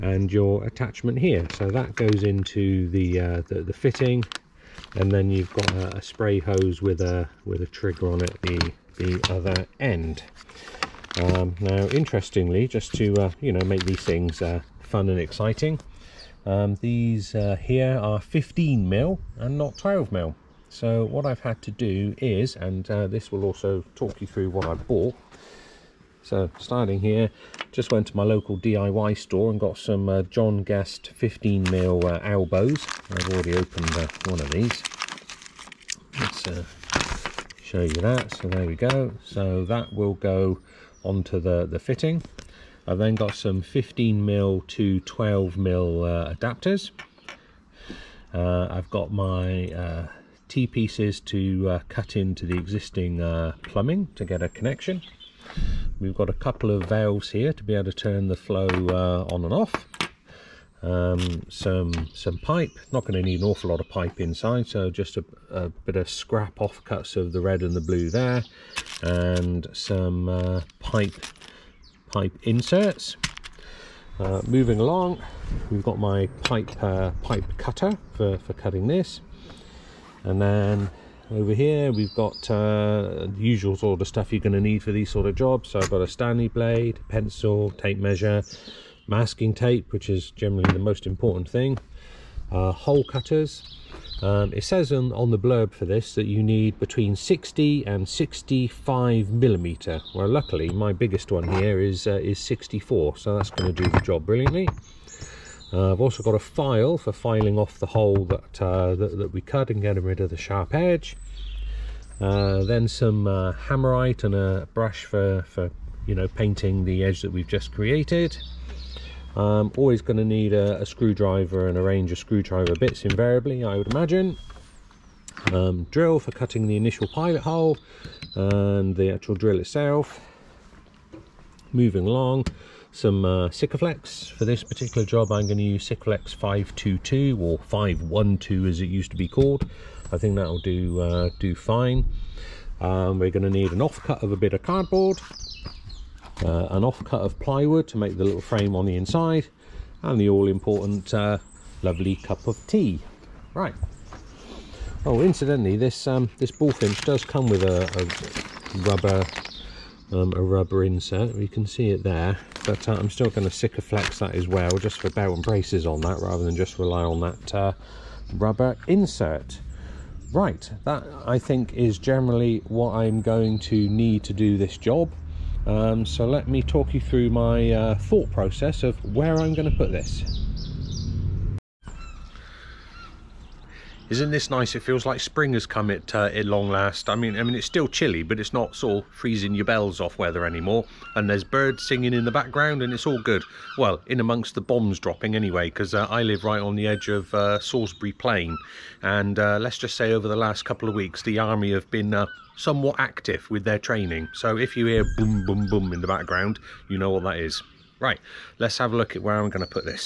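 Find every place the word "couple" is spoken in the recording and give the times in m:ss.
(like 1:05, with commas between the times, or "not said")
0:56, 3:20.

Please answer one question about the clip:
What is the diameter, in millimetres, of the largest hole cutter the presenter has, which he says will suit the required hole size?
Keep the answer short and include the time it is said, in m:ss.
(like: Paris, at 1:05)
64, at 1:42.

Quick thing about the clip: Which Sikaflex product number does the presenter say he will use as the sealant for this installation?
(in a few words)
522.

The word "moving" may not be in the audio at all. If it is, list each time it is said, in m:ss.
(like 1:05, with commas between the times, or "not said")
1:14, 2:11.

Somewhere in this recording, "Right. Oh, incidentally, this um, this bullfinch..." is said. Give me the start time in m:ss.
2:33.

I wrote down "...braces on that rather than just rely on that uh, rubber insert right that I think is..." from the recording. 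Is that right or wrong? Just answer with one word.
right.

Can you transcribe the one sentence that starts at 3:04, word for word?
It feels like spring has come at, uh, at long last.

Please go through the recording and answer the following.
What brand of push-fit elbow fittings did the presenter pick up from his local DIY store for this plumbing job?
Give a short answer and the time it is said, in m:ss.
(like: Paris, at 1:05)
John Guest, at 0:30.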